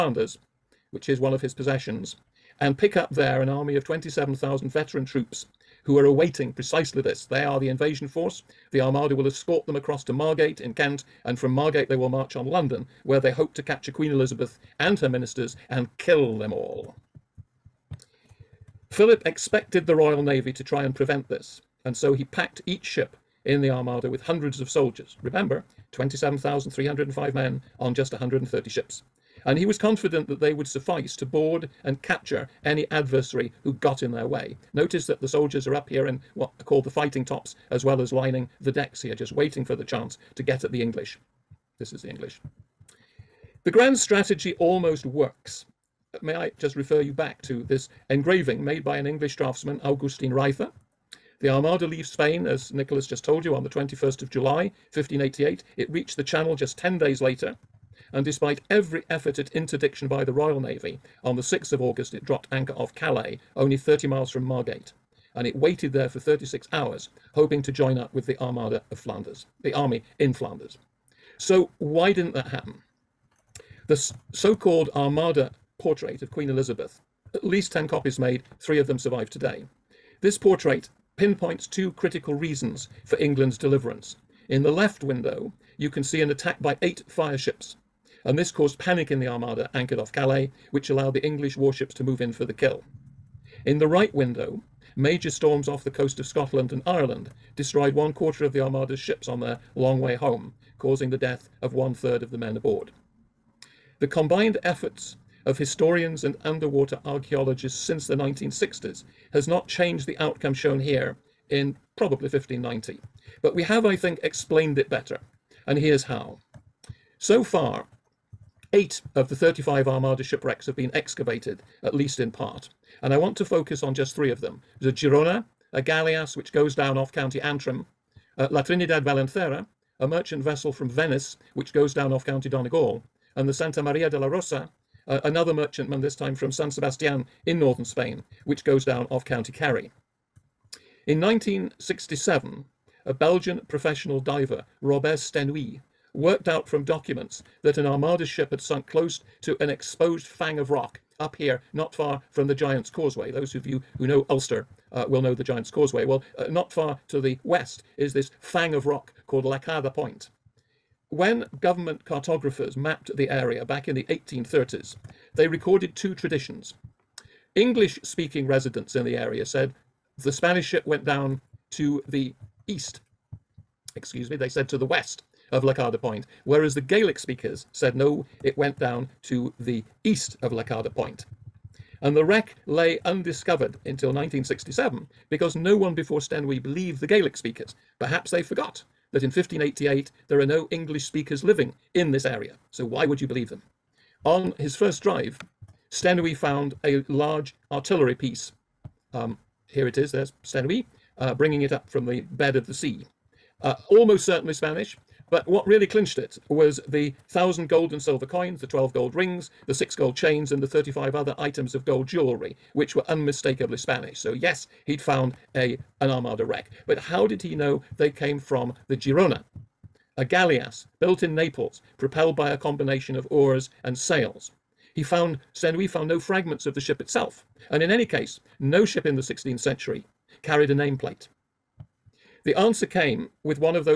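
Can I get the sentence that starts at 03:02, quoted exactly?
And the wreck lay undiscovered until 1967 because no one before Sténuit believed the Gaelic speakers.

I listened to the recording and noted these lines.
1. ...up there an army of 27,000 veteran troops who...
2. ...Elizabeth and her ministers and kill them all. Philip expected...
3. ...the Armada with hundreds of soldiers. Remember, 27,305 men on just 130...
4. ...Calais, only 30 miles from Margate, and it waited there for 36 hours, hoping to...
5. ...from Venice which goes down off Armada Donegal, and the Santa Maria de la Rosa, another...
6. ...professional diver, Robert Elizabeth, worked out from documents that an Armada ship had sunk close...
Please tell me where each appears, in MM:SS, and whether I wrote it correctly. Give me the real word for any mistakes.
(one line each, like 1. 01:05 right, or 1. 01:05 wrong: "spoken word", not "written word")
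1. 00:02 right
2. 00:14 right
3. 00:23 right
4. 01:02 right
5. 02:10 wrong: "County", not "Armada"
6. 02:23 wrong: "Sténuit", not "Elizabeth".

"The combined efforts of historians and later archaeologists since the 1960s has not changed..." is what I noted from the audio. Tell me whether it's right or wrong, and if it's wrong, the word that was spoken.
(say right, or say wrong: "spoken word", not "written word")
wrong: "underwater", not "later".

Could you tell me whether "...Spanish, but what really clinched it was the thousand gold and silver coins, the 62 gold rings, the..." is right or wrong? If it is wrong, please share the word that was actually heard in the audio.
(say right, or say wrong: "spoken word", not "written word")
wrong: "12", not "62".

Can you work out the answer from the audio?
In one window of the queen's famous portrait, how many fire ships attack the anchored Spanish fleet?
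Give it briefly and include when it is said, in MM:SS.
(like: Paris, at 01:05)
8, at 01:26.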